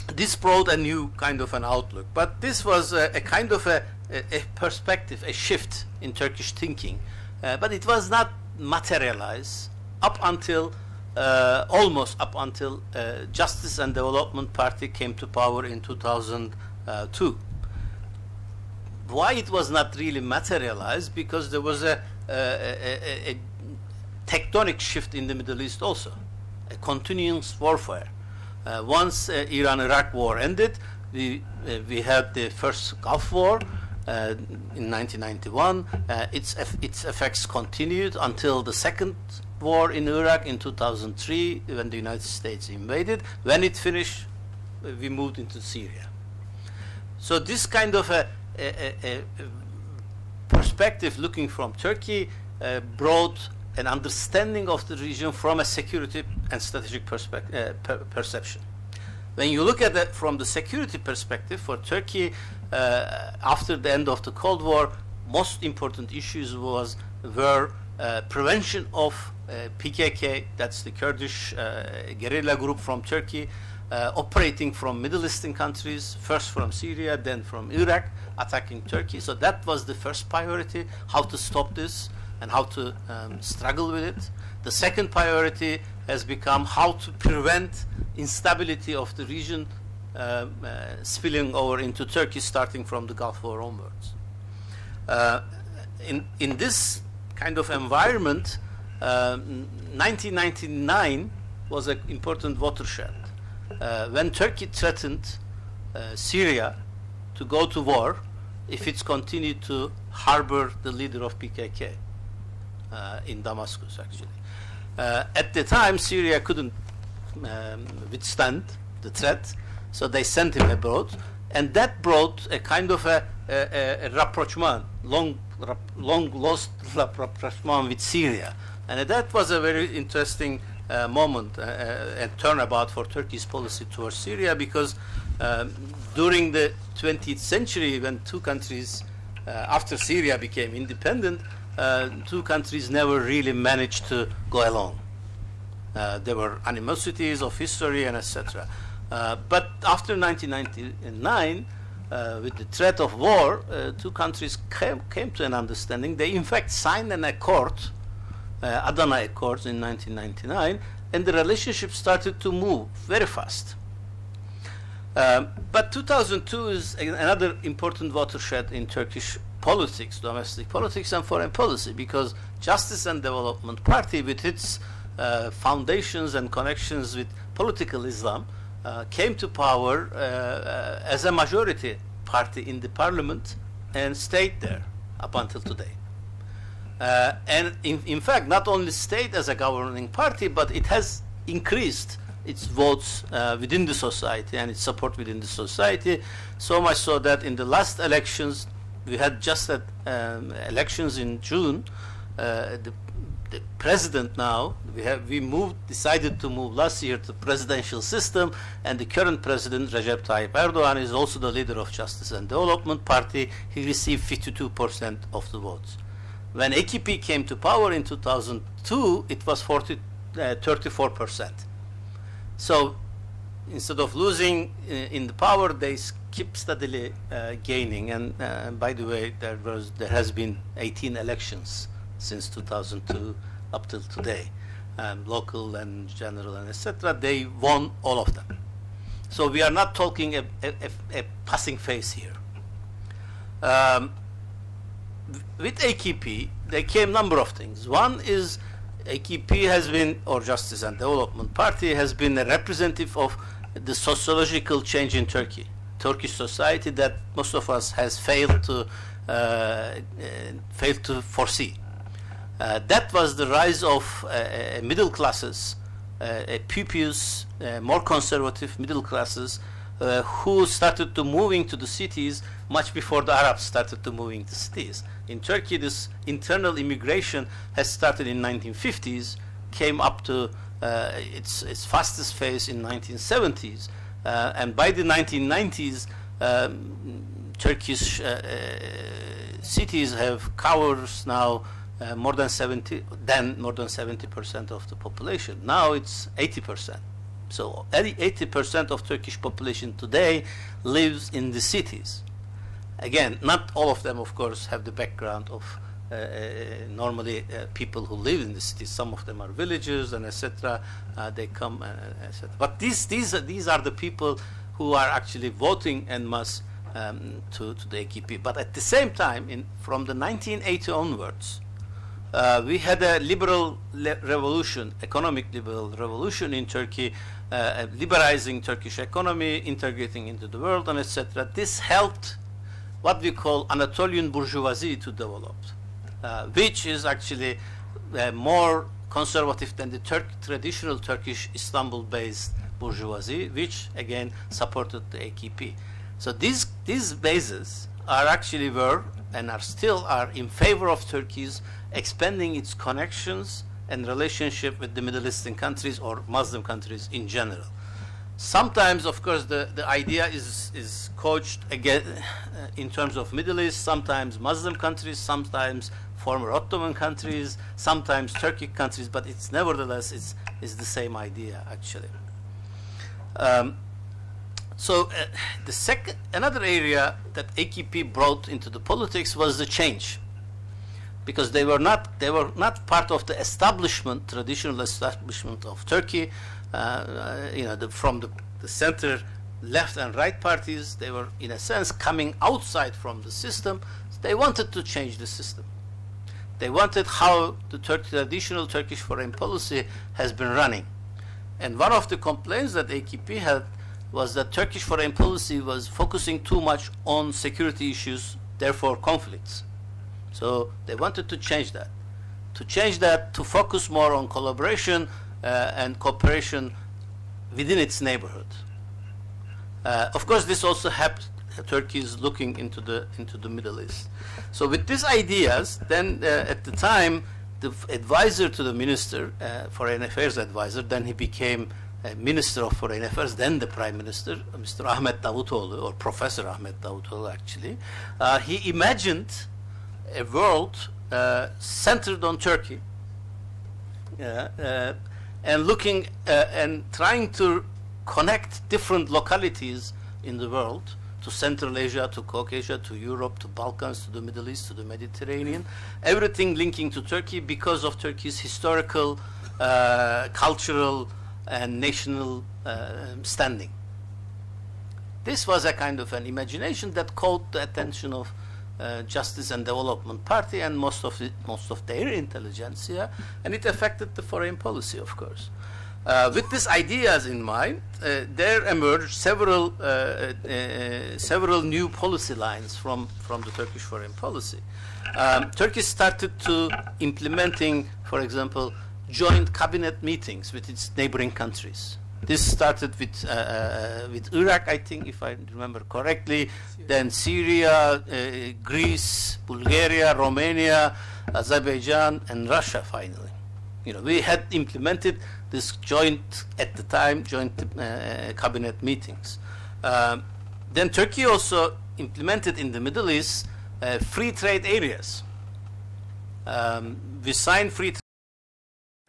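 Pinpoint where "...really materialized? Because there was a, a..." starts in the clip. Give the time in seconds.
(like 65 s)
19 s.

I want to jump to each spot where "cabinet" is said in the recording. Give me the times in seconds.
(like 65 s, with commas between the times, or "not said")
489 s, 508 s.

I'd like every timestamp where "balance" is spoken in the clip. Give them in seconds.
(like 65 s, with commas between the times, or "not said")
not said.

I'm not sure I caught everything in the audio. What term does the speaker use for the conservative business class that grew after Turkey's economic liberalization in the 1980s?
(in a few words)
Anatolian bourgeoisie.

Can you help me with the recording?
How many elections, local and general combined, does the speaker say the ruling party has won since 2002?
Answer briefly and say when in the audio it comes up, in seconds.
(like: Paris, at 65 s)
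18, at 230 s.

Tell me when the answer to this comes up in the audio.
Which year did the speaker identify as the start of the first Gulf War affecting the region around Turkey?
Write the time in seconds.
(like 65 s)
34 s.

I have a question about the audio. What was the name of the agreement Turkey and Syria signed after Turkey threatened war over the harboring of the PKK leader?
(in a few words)
Adana Accord.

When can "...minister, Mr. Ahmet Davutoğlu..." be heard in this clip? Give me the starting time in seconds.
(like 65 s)
433 s.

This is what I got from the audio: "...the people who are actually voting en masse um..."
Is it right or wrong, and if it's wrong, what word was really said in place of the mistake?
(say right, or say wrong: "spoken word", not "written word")
right.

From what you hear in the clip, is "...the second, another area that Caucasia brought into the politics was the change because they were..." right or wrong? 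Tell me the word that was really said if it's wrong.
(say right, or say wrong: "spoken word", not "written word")
wrong: "AKP", not "Caucasia".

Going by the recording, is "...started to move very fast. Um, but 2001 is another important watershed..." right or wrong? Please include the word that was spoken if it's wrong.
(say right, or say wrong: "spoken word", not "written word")
wrong: "2002", not "2001".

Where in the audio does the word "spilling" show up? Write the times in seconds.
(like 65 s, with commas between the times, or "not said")
91 s.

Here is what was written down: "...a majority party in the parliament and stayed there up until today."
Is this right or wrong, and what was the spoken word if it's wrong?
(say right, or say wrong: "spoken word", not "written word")
right.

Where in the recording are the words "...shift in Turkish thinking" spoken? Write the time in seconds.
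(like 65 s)
5 s.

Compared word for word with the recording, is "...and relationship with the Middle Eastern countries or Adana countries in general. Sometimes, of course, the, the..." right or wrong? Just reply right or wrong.
wrong.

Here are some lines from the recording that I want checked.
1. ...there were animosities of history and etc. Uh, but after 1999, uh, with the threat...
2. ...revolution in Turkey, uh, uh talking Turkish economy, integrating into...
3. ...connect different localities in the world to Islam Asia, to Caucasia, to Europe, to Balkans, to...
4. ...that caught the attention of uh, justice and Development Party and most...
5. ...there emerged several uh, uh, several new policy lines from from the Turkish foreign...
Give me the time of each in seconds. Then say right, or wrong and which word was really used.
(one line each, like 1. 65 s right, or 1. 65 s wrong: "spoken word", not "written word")
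1. 146 s right
2. 325 s wrong: "liberalizing", not "talking"
3. 448 s wrong: "Central", not "Islam"
4. 466 s right
5. 478 s right.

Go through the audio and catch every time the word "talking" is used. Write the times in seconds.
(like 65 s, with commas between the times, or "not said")
239 s.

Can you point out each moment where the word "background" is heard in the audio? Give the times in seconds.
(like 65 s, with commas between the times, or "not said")
304 s.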